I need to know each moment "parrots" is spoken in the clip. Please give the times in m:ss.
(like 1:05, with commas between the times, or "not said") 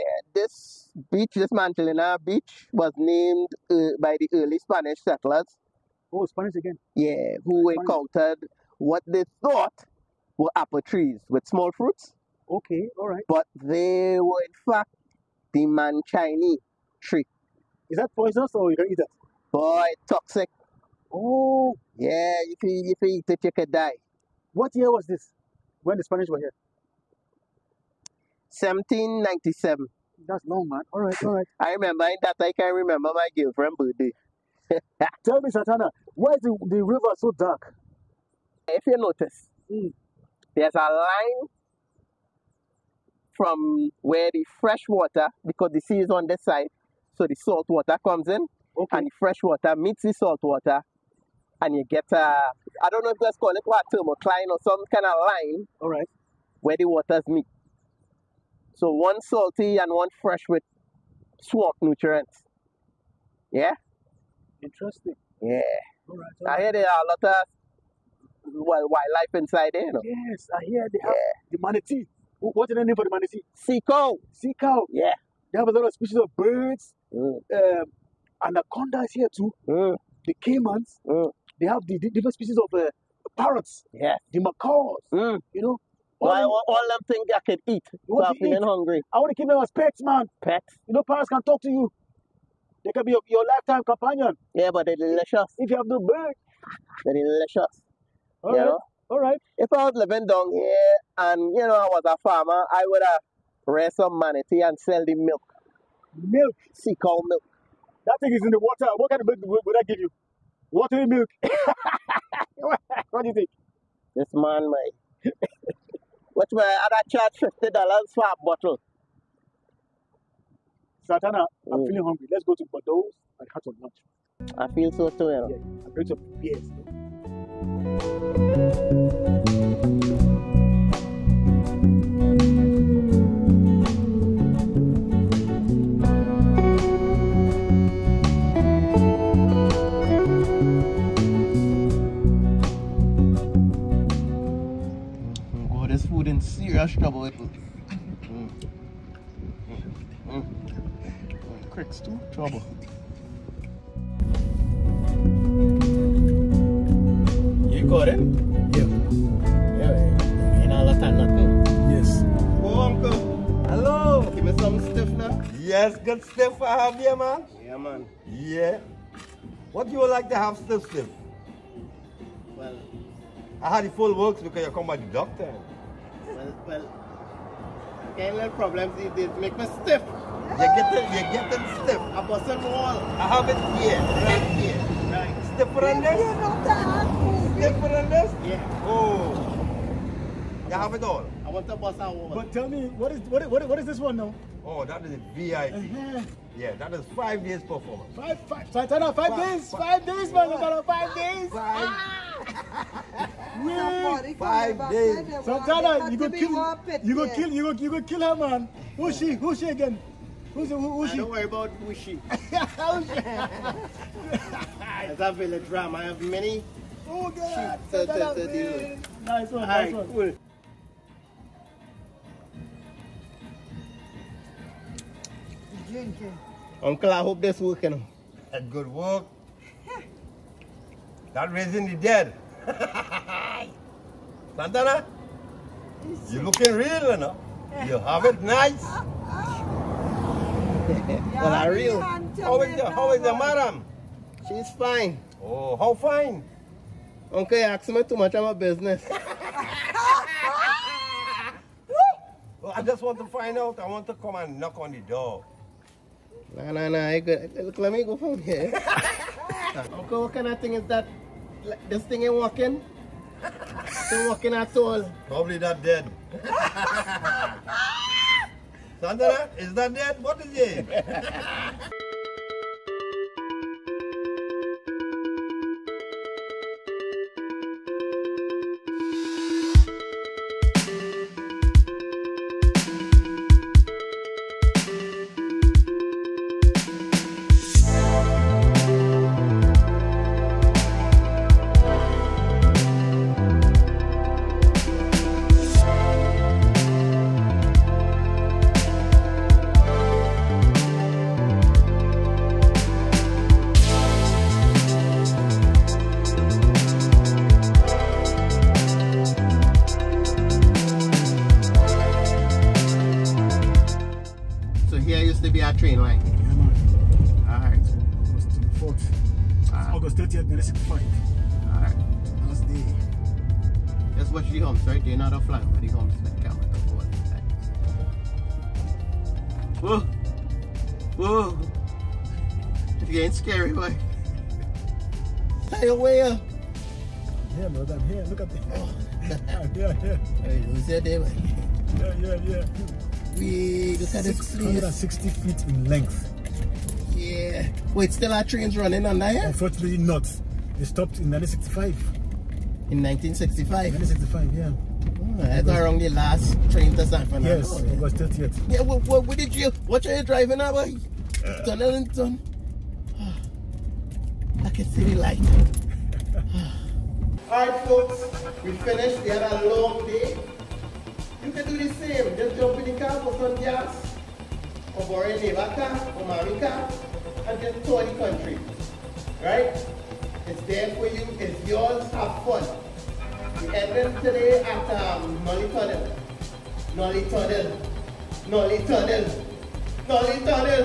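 1:23, 1:31.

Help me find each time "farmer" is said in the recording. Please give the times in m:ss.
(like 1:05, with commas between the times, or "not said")
1:42.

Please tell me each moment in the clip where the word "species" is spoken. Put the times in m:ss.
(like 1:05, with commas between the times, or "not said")
1:15, 1:22.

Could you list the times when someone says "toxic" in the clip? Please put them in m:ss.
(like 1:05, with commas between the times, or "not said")
0:20.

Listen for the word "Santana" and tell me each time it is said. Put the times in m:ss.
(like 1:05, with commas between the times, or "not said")
0:35, 2:01, 3:25, 3:54.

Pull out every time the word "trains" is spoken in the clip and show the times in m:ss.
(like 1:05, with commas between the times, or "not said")
5:48, 5:56.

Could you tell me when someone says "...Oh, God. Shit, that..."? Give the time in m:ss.
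3:37.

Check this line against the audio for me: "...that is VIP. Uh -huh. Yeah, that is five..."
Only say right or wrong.
right.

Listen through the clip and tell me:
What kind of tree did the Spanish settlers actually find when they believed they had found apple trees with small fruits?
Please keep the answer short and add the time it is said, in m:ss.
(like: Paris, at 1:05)
manchini tree, at 0:15.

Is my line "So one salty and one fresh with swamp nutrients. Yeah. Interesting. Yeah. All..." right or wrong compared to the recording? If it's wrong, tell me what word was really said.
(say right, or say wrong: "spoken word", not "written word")
right.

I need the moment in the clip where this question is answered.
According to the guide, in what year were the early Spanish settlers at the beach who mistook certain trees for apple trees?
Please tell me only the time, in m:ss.
0:28.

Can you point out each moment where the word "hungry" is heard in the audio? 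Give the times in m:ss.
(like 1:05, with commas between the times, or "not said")
1:28, 2:02.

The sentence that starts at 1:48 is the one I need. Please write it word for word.
That thing is in the water.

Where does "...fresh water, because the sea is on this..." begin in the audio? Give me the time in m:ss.
0:44.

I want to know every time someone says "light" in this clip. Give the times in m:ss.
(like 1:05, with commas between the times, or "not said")
6:05.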